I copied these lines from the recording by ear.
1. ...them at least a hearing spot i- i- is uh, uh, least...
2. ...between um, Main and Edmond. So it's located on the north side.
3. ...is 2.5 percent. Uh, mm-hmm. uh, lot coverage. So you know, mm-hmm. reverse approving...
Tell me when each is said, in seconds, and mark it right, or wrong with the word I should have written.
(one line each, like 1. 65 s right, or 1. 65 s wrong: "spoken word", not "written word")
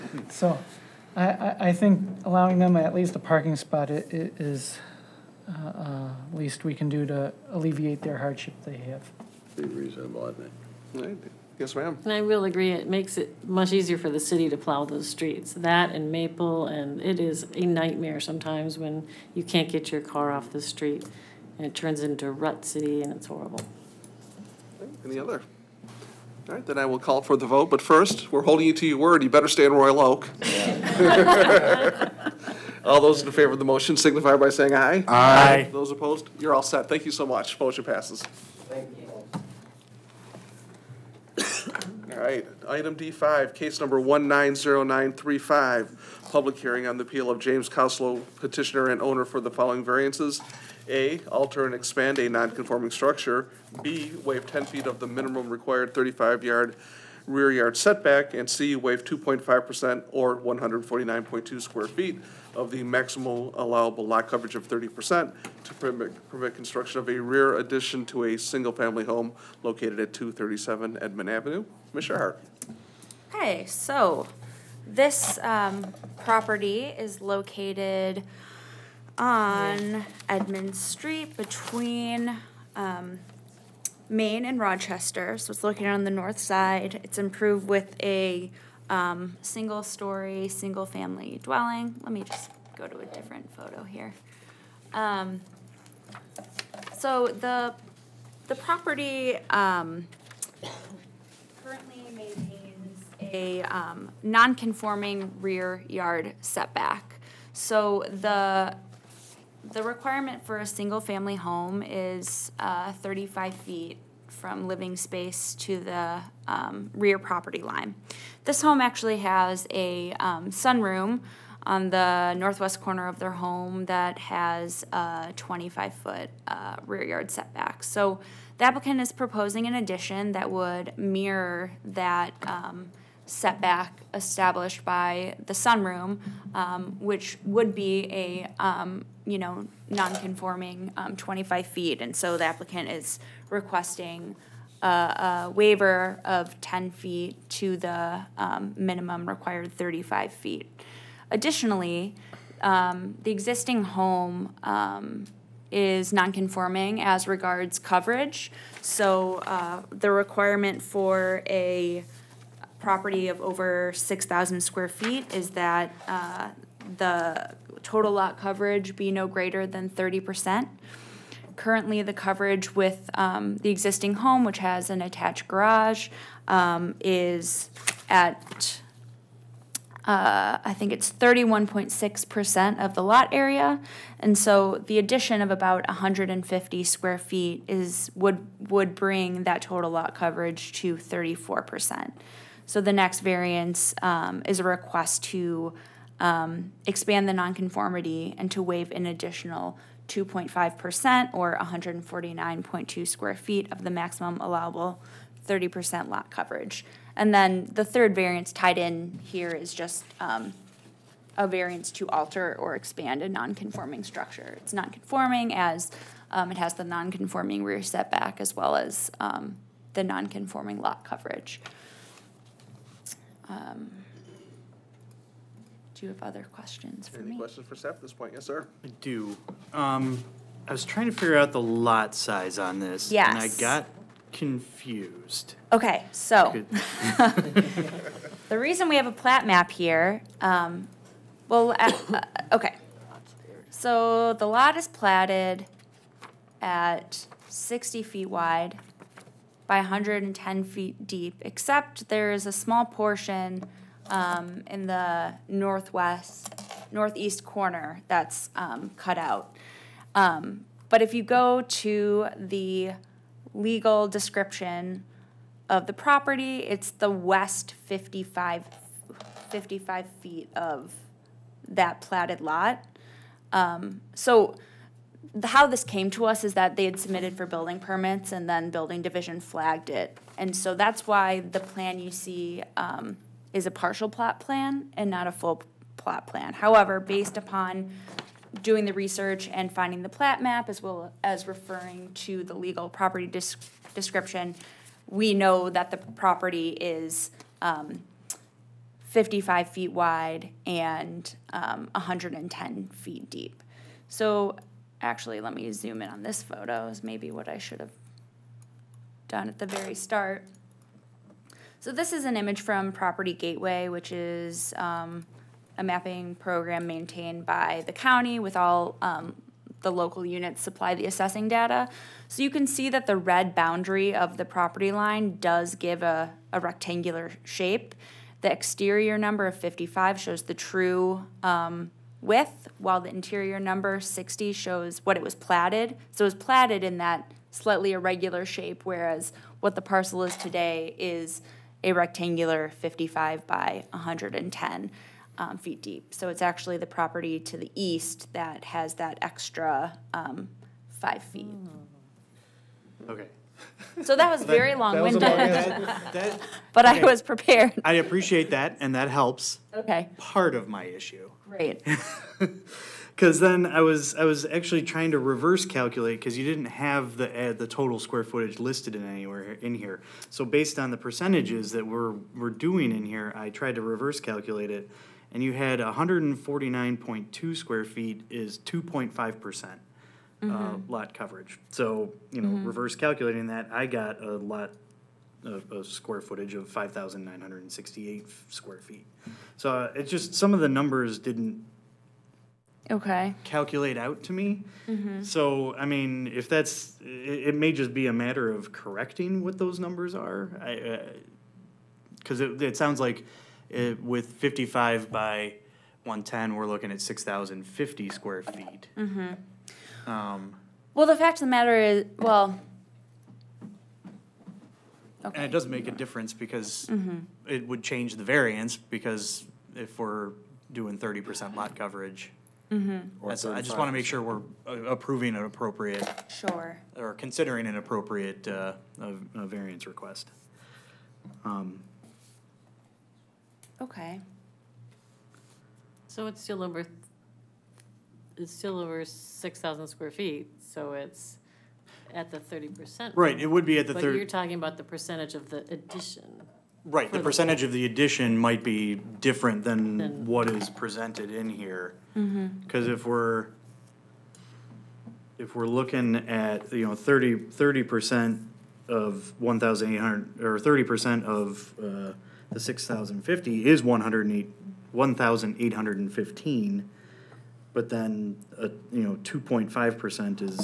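1. 2 s wrong: "parking", not "hearing"
2. 81 s wrong: "Rochester", not "Edmond"
3. 378 s wrong: "calculating", not "approving".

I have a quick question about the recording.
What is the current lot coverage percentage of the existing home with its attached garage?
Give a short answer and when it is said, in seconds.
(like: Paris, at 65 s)
31.6%, at 181 s.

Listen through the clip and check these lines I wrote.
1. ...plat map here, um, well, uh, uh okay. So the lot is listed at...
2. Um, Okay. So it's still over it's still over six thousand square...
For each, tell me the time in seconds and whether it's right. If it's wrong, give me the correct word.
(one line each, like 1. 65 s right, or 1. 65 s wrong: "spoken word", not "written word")
1. 239 s wrong: "platted", not "listed"
2. 431 s right.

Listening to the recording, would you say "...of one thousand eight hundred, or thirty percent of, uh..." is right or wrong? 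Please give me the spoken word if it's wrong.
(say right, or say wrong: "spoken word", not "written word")
right.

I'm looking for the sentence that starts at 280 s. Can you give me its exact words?
And so that's why the plan you see um, is a partial plot plan and not a full plot plan.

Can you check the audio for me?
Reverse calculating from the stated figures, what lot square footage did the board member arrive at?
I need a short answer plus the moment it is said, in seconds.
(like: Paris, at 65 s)
5968 square feet, at 386 s.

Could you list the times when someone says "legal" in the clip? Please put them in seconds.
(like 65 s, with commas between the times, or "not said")
263 s, 292 s.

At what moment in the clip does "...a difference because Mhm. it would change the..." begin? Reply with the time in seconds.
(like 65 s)
415 s.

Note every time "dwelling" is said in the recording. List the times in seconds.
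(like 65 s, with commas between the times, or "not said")
91 s.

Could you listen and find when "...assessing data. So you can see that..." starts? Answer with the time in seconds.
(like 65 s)
321 s.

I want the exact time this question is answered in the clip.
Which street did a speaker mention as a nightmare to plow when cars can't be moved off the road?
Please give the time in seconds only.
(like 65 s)
16 s.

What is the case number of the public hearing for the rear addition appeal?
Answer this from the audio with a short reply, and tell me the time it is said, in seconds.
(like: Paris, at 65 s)
190935, at 43 s.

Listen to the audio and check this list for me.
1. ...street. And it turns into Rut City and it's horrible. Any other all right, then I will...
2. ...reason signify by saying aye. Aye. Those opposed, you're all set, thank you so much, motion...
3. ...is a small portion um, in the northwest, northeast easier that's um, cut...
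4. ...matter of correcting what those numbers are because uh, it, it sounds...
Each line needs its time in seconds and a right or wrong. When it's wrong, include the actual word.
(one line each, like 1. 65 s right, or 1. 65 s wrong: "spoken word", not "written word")
1. 20 s right
2. 33 s wrong: "motion", not "reason"
3. 252 s wrong: "corner", not "easier"
4. 398 s right.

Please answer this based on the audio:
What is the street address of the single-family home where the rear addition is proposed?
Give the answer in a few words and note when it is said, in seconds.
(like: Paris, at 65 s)
237 Edmond Avenue, at 70 s.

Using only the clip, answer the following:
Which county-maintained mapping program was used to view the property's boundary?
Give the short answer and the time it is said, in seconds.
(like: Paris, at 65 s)
Property Gateway, at 312 s.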